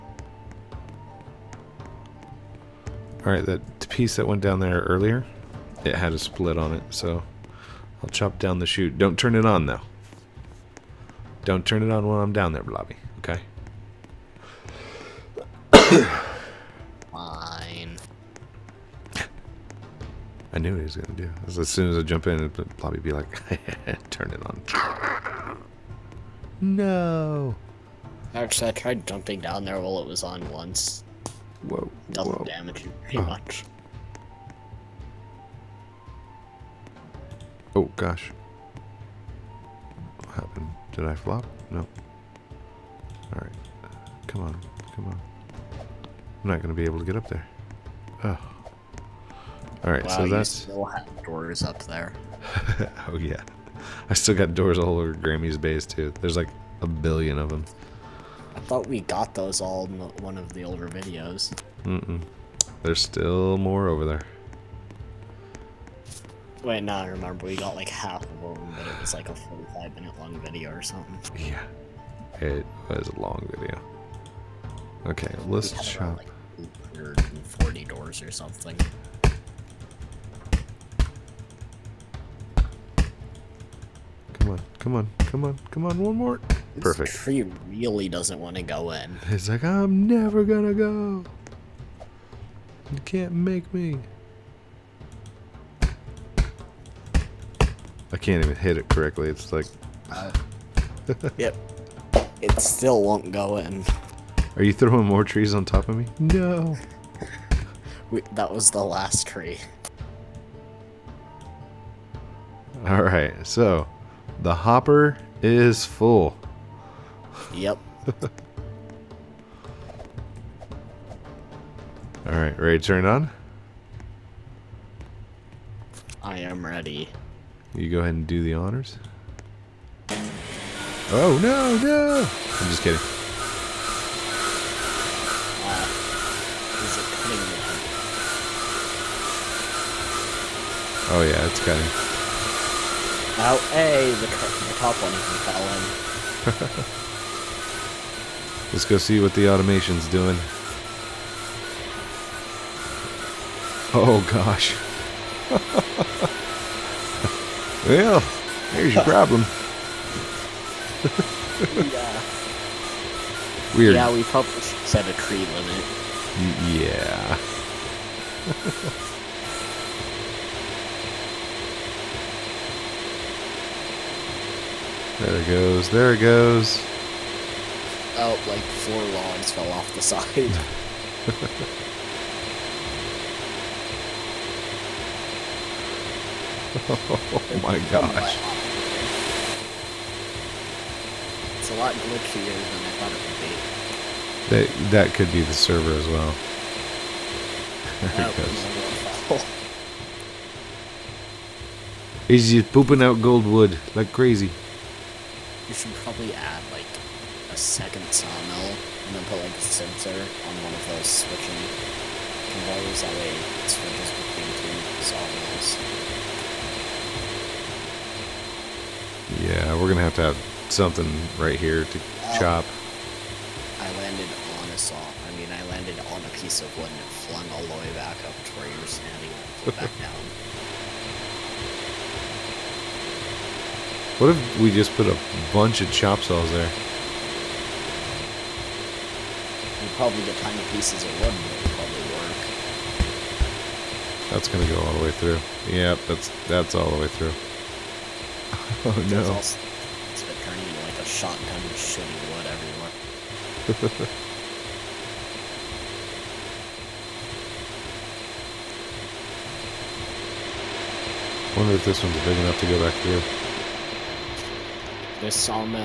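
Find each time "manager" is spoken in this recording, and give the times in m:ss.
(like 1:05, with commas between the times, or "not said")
not said.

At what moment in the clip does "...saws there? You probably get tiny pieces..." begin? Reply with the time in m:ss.
3:56.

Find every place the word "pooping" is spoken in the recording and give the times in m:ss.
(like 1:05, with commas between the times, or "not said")
3:22.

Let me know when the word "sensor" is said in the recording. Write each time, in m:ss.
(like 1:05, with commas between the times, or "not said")
3:29.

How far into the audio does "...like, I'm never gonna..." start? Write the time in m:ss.
1:29.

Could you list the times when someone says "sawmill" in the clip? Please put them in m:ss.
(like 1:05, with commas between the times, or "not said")
3:28, 3:35.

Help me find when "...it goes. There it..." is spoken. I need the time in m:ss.
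2:55.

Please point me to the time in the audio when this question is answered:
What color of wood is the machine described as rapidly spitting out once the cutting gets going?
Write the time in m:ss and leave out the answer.
3:23.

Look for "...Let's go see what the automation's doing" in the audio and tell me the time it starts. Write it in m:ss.
2:28.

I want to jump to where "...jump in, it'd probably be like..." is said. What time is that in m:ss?
0:22.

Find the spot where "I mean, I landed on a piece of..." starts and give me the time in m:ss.
3:44.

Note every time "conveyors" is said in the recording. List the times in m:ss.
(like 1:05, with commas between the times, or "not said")
3:32.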